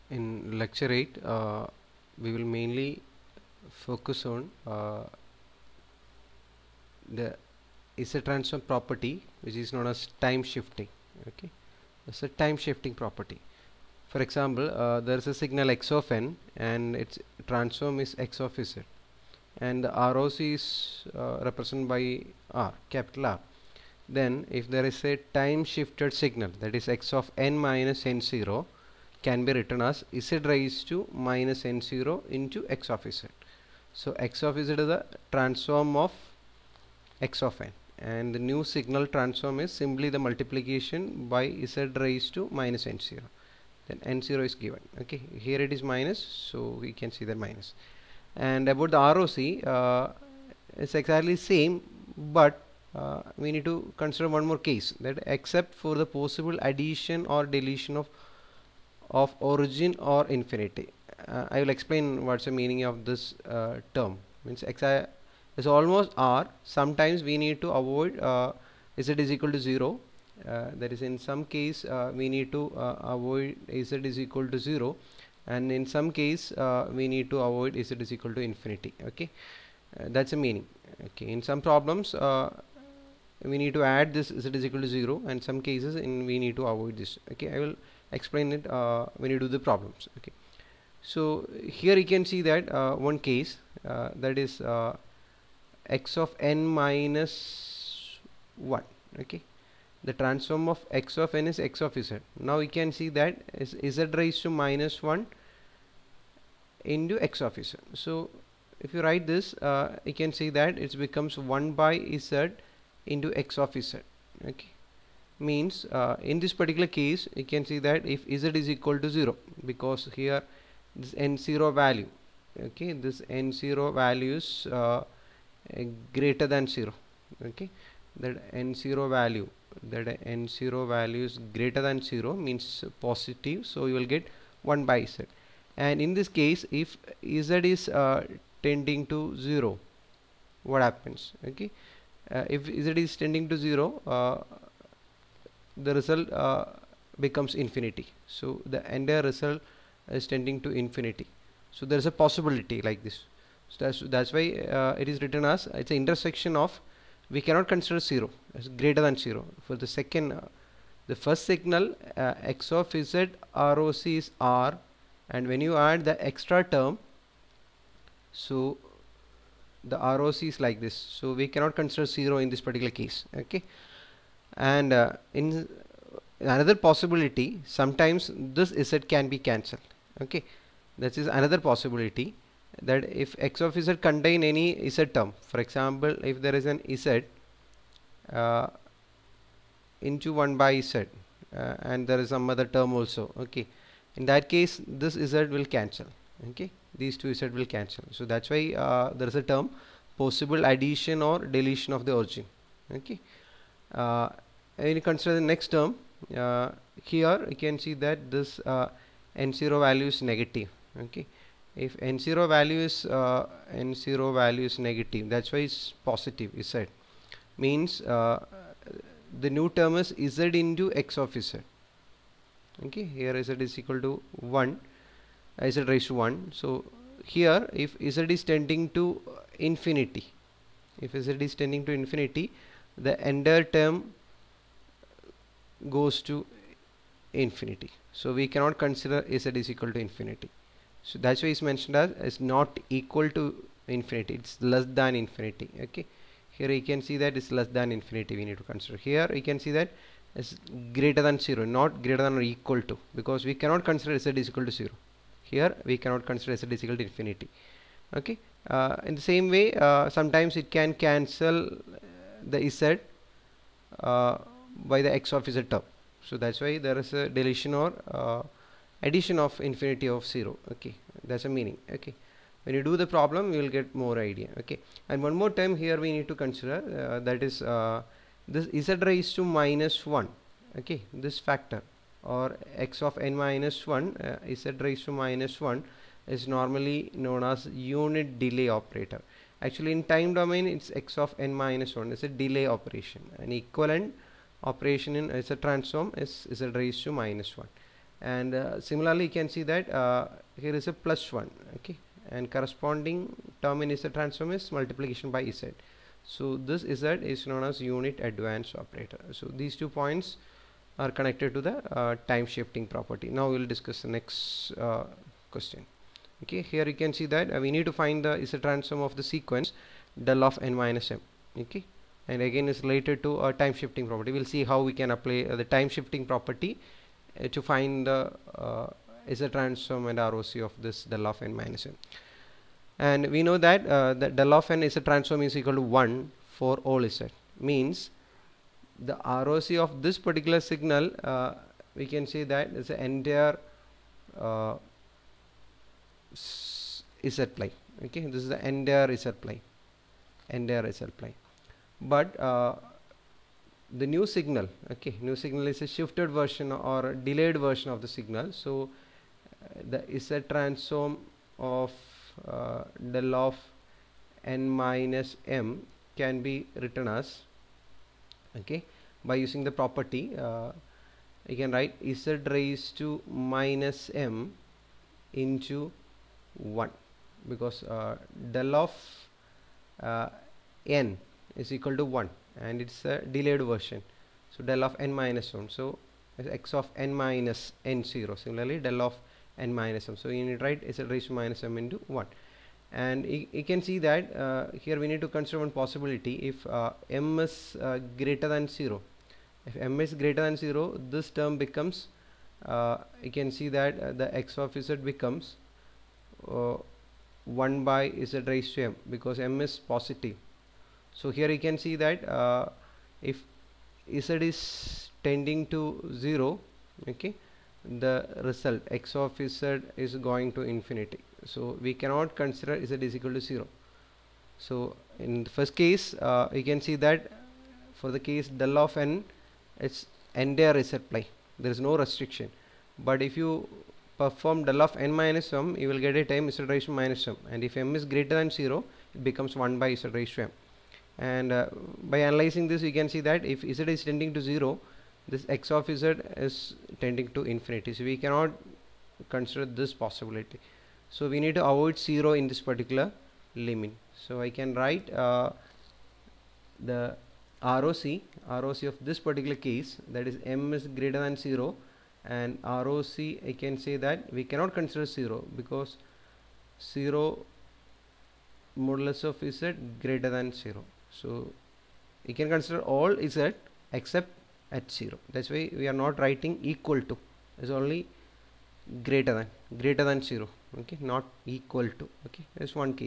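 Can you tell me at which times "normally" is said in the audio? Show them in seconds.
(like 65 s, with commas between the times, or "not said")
286 s.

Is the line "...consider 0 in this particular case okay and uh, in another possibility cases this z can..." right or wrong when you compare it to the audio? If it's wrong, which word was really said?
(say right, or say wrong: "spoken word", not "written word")
wrong: "sometimes", not "cases".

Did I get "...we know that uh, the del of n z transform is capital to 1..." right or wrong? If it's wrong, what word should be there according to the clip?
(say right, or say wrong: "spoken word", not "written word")
wrong: "equal", not "capital".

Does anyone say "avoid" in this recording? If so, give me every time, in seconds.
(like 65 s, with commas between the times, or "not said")
67 s, 73 s, 77 s, 86 s, 451 s.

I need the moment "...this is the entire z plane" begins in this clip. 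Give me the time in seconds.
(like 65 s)
348 s.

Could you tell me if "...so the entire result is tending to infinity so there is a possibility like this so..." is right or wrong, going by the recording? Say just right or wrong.
right.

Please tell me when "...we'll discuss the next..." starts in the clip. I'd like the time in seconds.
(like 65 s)
313 s.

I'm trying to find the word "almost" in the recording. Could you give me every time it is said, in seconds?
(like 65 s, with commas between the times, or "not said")
65 s.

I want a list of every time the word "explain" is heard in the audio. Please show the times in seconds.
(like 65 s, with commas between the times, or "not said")
61 s, 88 s.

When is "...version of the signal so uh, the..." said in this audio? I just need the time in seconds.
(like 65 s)
357 s.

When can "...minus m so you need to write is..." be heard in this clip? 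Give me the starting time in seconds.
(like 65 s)
389 s.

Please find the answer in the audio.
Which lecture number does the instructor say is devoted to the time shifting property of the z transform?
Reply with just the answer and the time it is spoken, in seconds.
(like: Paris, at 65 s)
8, at 0 s.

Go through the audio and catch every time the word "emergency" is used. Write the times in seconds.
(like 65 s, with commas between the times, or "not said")
not said.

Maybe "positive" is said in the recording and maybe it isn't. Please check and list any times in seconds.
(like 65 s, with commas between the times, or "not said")
133 s, 216 s, 409 s.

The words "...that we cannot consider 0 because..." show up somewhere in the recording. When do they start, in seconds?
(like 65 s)
463 s.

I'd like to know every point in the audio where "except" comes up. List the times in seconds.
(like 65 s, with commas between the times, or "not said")
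55 s, 473 s.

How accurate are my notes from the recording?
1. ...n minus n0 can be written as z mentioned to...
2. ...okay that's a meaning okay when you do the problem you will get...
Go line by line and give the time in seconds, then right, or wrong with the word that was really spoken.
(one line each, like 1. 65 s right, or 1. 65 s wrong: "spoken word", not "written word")
1. 27 s wrong: "raised", not "mentioned"
2. 270 s right.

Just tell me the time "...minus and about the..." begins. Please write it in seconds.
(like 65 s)
47 s.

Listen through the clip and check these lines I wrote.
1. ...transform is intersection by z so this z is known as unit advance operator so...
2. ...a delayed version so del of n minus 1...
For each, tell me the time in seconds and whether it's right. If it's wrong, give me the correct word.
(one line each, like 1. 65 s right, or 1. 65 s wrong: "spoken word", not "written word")
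1. 304 s wrong: "multiplication", not "intersection"
2. 383 s right.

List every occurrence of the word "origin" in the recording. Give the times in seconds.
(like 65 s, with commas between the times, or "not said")
59 s, 202 s.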